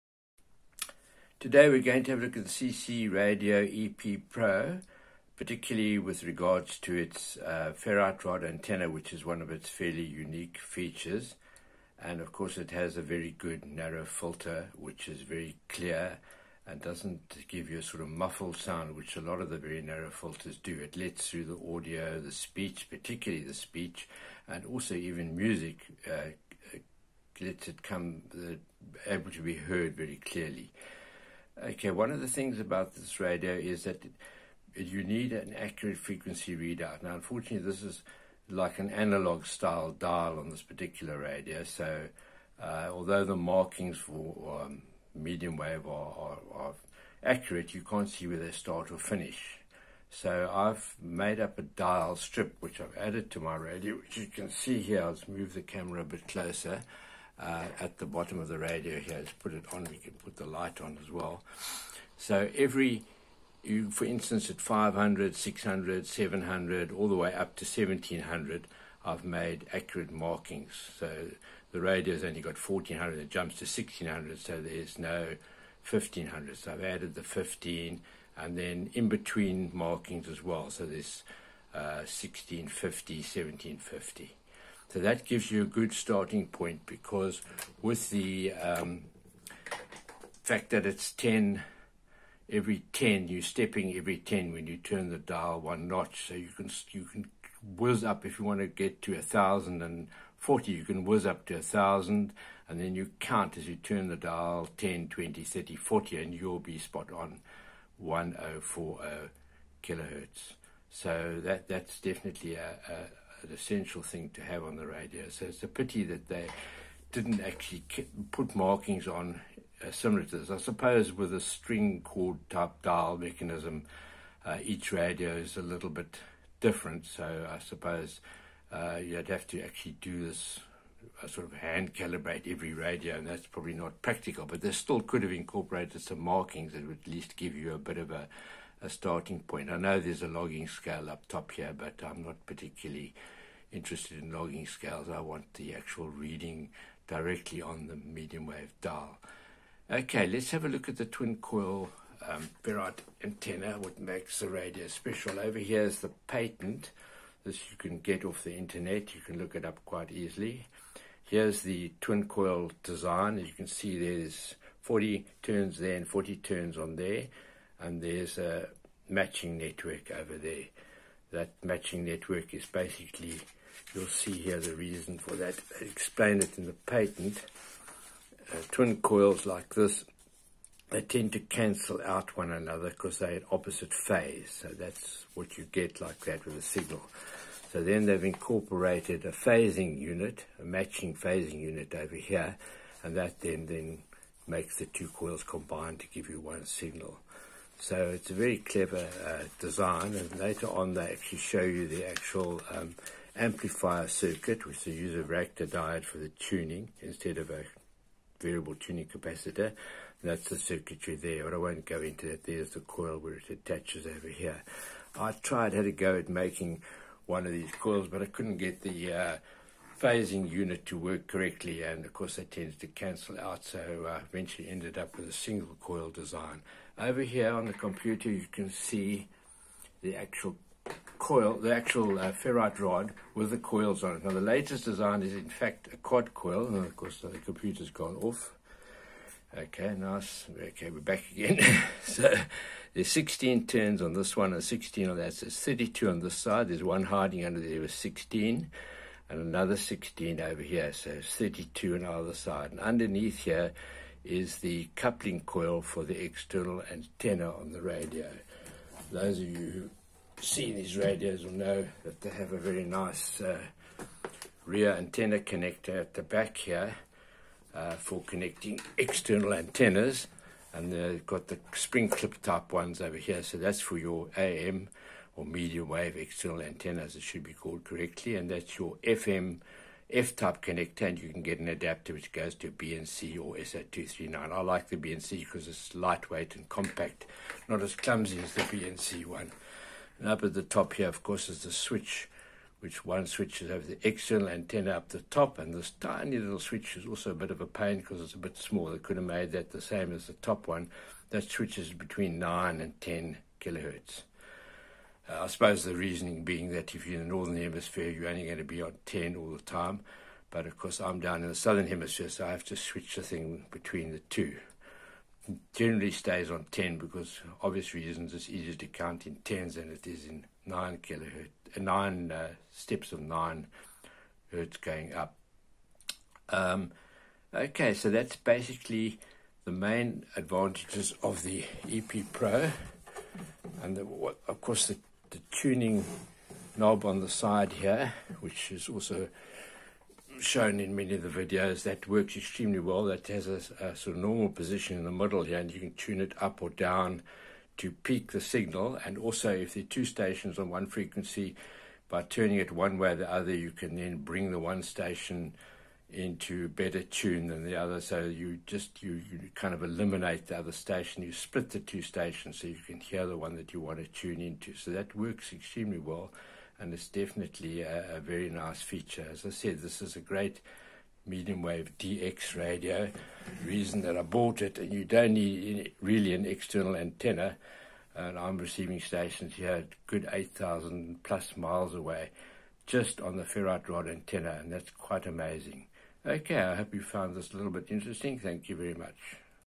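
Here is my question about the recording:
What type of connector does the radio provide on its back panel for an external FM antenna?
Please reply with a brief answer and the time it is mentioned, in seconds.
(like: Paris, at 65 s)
F type connector, at 280 s.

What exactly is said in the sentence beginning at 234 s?
Now the latest design is in fact a quad coil, and of course the computer's gone off.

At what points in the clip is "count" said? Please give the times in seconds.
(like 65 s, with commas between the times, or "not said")
103 s, 318 s.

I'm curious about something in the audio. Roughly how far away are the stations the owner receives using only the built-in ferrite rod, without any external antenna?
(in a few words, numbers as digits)
8,000 plus miles.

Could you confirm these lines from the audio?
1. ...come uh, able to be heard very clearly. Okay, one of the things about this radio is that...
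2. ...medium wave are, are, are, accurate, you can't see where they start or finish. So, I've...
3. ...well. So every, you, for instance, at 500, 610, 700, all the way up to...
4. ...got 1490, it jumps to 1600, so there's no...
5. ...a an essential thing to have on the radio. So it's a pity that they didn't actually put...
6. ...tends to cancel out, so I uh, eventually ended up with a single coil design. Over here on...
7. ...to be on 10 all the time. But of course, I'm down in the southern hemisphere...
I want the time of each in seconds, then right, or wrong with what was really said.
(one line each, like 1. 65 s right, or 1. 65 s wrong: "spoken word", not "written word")
1. 27 s right
2. 45 s right
3. 61 s wrong: "600", not "610"
4. 72 s wrong: "1400", not "1490"
5. 112 s right
6. 222 s right
7. 308 s right.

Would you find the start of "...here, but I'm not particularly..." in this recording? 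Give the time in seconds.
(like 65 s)
141 s.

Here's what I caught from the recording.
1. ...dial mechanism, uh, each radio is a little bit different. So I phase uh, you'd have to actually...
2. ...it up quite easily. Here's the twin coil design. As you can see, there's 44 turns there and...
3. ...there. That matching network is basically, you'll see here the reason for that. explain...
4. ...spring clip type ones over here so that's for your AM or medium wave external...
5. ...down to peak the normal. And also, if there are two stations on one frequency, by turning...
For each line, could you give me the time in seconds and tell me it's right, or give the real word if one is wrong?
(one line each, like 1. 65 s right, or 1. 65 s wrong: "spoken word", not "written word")
1. 122 s wrong: "suppose", not "phase"
2. 159 s wrong: "40", not "44"
3. 170 s right
4. 271 s right
5. 346 s wrong: "signal", not "normal".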